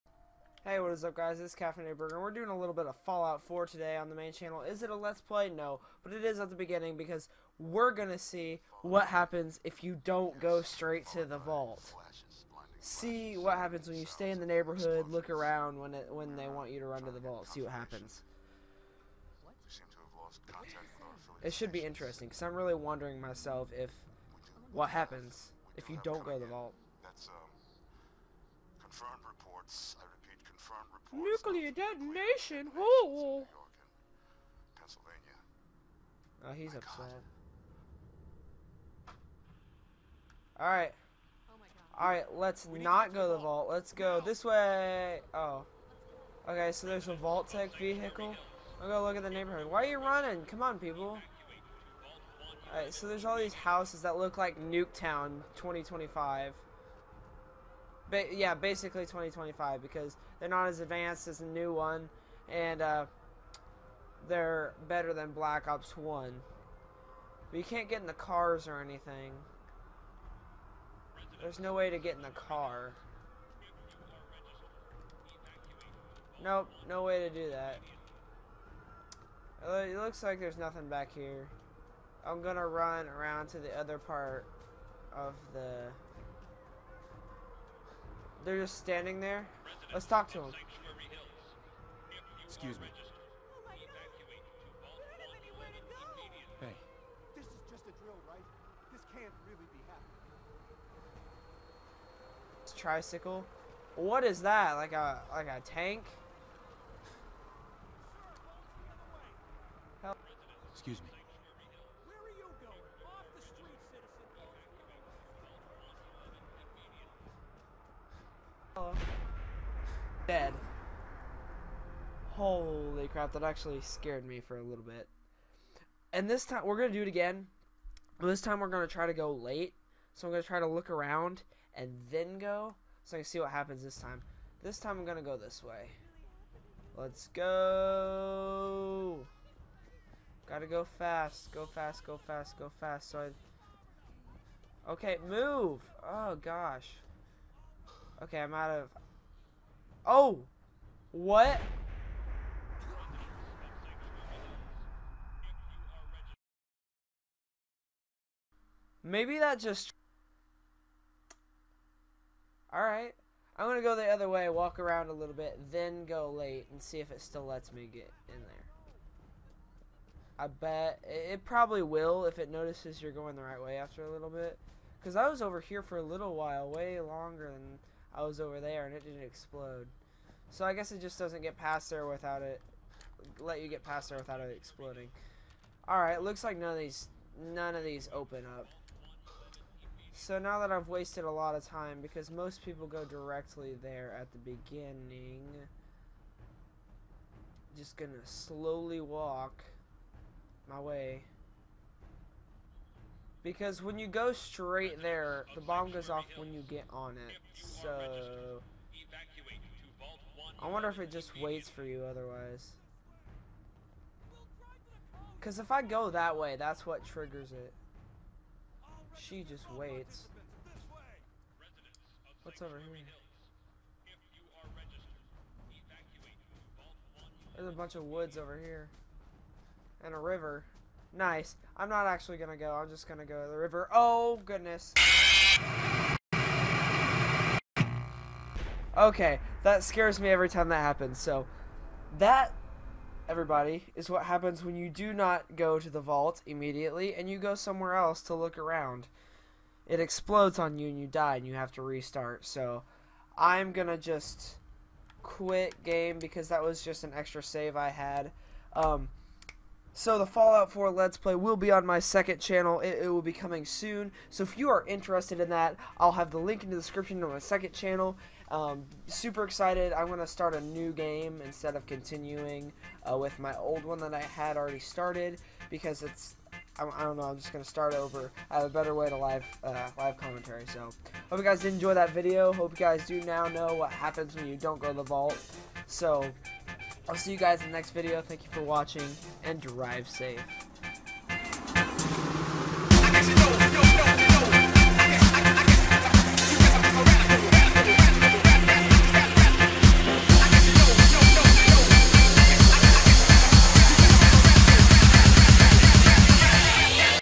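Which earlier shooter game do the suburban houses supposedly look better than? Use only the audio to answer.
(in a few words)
Black Ops One.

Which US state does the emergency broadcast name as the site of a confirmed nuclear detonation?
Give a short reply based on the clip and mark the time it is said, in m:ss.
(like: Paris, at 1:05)
Pennsylvania, at 0:34.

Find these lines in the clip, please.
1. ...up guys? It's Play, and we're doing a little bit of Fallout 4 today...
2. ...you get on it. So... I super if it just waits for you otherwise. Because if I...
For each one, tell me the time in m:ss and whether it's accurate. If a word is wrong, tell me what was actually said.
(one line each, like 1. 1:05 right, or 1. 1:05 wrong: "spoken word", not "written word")
1. 0:01 wrong: "Kaffenatedberger", not "Play"
2. 3:26 wrong: "wonder", not "super".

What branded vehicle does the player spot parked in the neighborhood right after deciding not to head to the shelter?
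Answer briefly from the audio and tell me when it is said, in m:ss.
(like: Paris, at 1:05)
Vault-Tec vehicle, at 0:47.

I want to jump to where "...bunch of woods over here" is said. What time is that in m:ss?
3:47.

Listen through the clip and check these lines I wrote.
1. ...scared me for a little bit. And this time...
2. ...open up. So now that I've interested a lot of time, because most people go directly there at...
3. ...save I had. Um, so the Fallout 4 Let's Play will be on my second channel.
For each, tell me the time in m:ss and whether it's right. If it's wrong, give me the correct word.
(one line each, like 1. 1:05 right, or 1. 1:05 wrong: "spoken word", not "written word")
1. 2:03 right
2. 3:08 wrong: "wasted", not "interested"
3. 4:17 right.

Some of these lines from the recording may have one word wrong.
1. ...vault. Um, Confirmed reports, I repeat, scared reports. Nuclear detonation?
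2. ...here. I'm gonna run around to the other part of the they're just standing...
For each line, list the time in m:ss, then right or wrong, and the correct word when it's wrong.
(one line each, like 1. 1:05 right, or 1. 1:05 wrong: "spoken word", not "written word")
1. 0:26 wrong: "confirmed", not "scared"
2. 1:21 right.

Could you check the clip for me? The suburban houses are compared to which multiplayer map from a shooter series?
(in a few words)
Nuketown 2025.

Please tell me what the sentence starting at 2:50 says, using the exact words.
I bet it probably will if it notices you're going the right way after a little bit.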